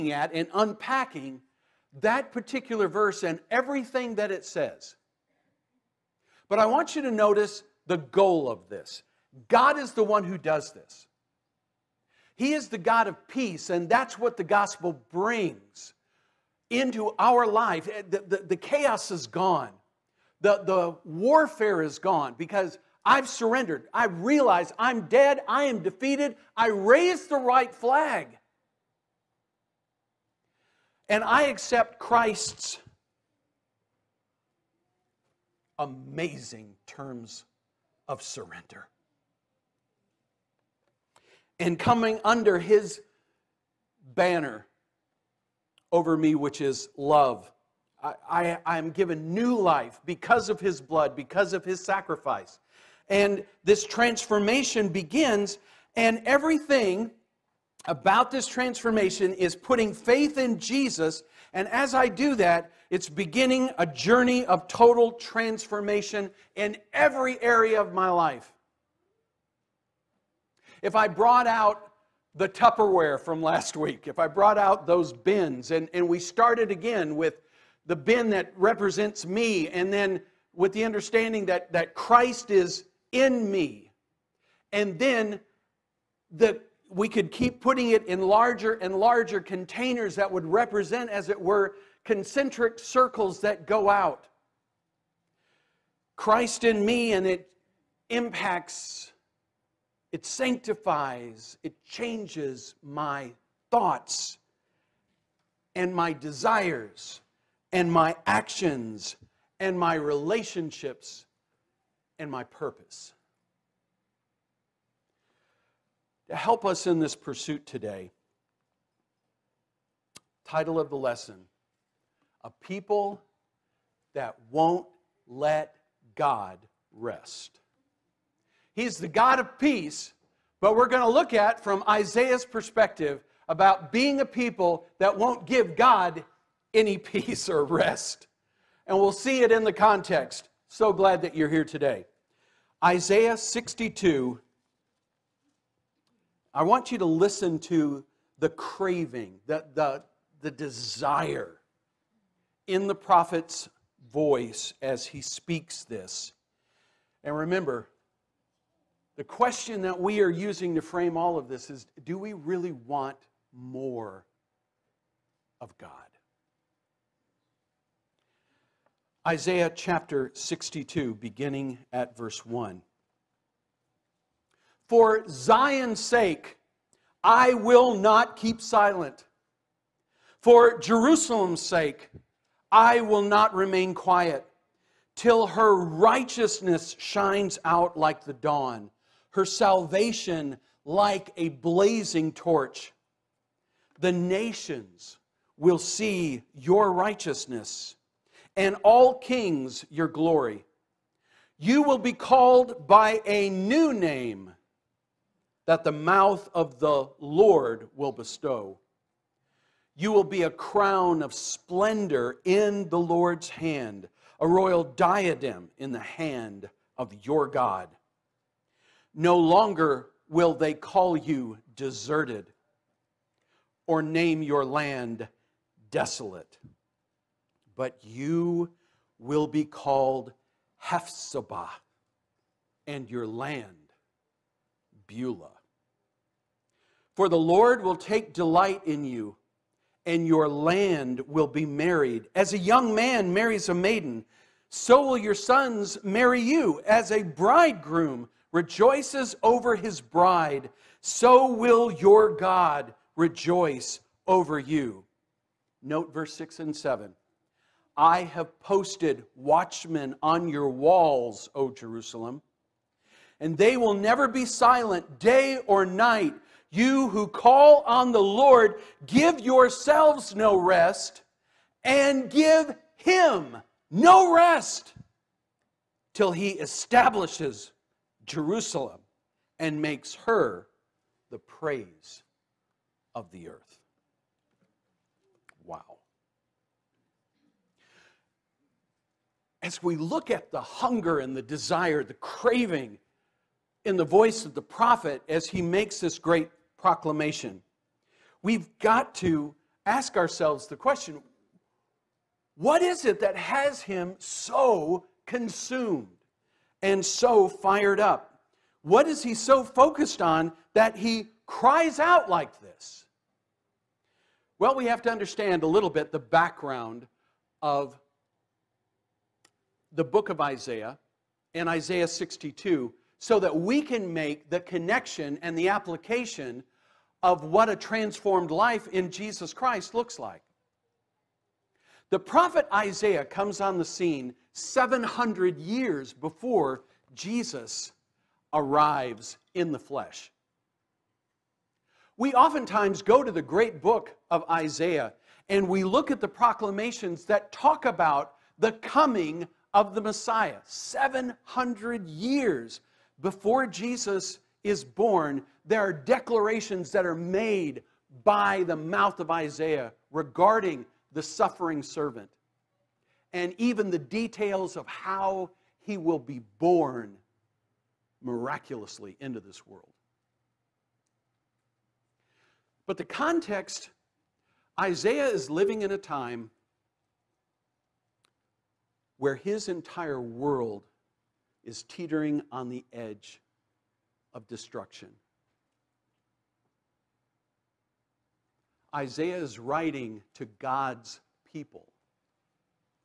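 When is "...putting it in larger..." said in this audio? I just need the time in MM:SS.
01:27.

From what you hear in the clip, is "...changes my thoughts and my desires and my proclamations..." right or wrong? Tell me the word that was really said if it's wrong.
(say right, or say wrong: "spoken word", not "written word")
wrong: "actions", not "proclamations".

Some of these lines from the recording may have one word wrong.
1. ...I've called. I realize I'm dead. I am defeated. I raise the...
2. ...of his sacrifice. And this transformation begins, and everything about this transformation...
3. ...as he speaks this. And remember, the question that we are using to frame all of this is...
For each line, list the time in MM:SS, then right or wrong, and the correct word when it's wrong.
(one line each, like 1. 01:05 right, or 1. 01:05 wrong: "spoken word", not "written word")
1. 00:23 wrong: "surrendered", not "called"
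2. 00:51 right
3. 02:34 right.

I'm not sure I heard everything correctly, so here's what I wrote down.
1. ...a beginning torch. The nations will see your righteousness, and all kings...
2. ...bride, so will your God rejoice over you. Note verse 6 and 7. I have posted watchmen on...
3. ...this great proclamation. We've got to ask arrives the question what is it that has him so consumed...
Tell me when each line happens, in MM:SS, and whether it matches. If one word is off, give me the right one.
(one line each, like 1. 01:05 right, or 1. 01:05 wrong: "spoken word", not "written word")
1. 03:11 wrong: "blazing", not "beginning"
2. 04:10 right
3. 04:55 wrong: "ourselves", not "arrives".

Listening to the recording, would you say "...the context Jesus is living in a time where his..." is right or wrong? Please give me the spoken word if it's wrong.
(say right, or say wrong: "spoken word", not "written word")
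wrong: "Isaiah", not "Jesus".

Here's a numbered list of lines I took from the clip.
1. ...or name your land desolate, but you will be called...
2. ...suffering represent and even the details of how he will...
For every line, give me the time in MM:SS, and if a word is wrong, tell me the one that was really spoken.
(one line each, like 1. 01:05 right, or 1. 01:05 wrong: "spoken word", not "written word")
1. 03:43 right
2. 06:01 wrong: "servant", not "represent".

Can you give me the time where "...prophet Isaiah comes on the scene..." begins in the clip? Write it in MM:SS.
05:32.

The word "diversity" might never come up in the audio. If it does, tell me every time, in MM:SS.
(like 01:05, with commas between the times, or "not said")
not said.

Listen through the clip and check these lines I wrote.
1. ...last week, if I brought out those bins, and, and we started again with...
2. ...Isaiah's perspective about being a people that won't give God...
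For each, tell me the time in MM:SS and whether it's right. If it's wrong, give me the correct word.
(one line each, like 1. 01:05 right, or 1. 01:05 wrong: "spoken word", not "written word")
1. 01:13 right
2. 02:11 right.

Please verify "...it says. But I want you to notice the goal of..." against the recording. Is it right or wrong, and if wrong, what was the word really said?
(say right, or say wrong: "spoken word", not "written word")
right.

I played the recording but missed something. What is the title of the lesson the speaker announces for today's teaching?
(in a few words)
A People That Won't Let God Rest.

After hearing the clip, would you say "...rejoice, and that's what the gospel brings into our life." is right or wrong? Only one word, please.
wrong.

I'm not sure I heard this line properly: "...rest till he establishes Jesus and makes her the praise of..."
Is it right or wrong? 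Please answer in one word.
wrong.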